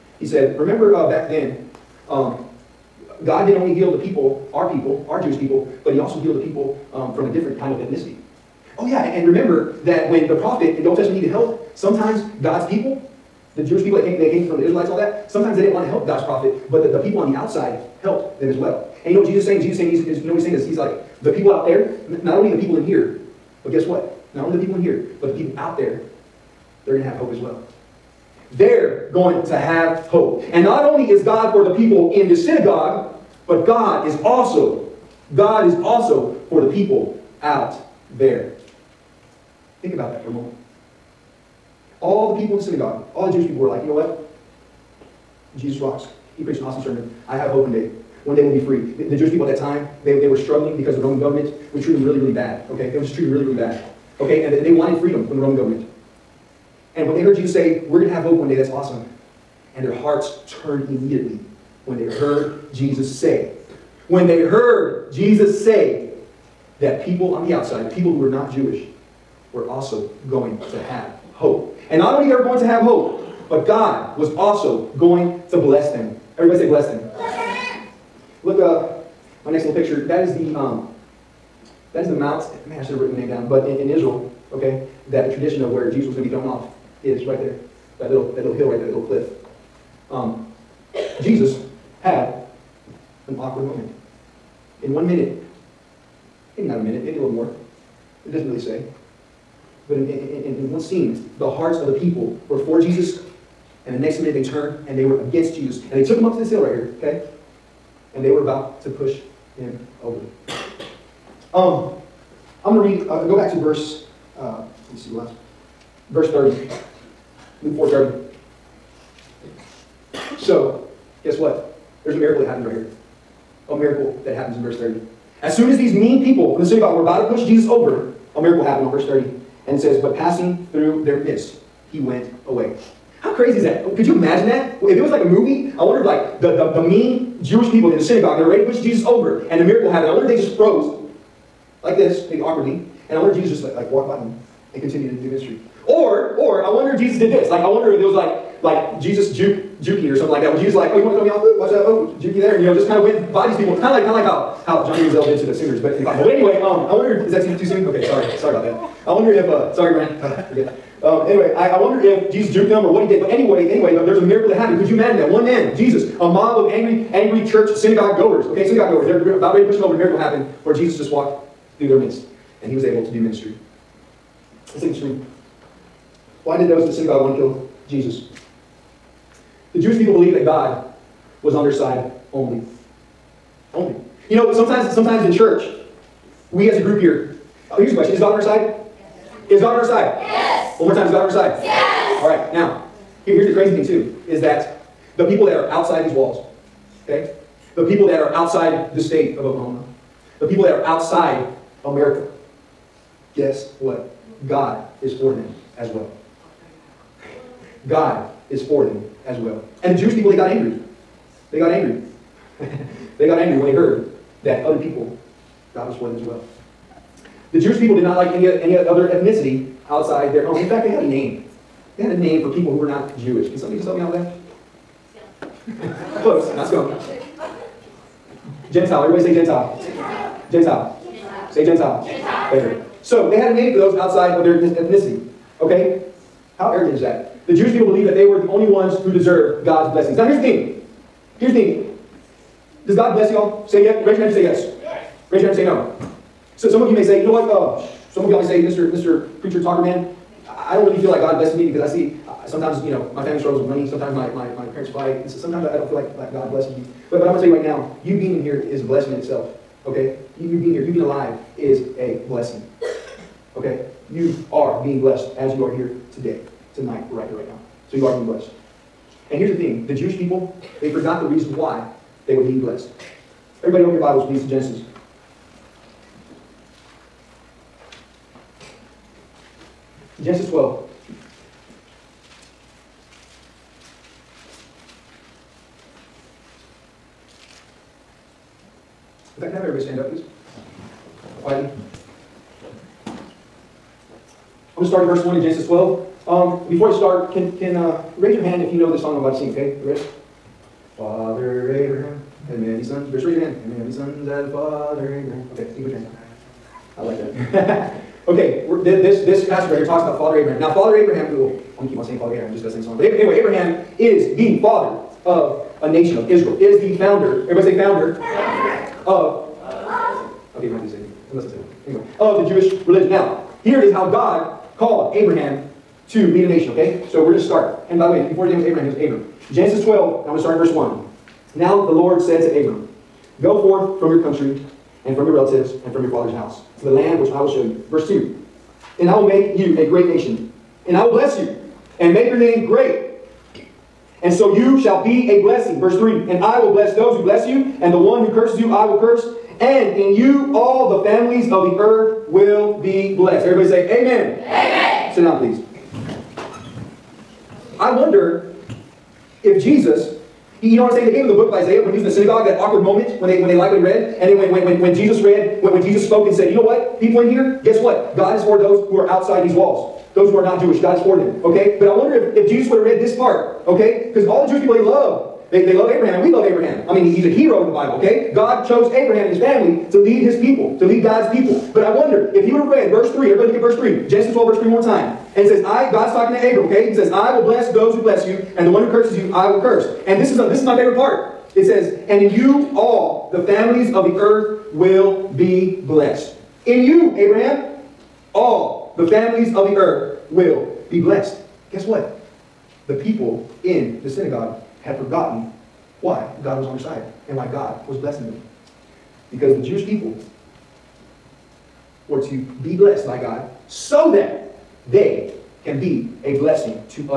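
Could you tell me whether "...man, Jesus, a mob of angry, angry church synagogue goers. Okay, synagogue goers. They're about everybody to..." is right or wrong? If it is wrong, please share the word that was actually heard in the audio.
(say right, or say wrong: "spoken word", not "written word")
wrong: "ready", not "everybody".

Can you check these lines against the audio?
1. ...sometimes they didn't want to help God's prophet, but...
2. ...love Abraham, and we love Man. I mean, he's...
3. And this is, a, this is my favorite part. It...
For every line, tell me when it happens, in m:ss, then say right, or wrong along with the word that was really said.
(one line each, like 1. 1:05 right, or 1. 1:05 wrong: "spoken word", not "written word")
1. 0:15 right
2. 6:15 wrong: "Abraham", not "Man"
3. 6:30 right.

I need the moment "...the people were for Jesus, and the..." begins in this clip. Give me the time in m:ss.
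1:41.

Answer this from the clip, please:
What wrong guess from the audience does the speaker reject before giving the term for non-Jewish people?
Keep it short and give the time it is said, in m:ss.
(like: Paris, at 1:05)
scum, at 3:46.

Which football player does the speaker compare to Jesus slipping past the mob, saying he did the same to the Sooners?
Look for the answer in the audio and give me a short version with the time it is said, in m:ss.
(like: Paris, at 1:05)
Johnny Manziel, at 2:34.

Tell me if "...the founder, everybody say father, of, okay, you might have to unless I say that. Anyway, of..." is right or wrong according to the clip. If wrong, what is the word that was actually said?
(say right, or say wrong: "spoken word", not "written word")
wrong: "founder", not "father".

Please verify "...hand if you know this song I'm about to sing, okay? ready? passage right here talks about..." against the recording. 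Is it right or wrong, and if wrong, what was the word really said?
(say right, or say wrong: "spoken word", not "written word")
right.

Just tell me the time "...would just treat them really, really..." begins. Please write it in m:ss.
0:52.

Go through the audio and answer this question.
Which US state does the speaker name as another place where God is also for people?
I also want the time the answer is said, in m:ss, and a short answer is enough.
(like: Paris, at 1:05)
Oklahoma, at 3:19.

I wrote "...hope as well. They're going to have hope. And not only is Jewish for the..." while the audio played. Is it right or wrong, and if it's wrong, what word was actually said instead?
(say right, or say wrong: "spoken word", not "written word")
wrong: "God", not "Jewish".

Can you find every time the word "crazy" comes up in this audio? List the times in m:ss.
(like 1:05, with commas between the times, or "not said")
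2:13, 3:13.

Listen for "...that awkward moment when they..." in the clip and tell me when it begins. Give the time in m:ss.
6:02.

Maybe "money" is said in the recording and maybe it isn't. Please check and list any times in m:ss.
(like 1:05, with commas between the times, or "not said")
4:13.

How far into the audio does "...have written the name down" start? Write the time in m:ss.
1:22.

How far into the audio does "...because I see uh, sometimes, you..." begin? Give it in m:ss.
4:11.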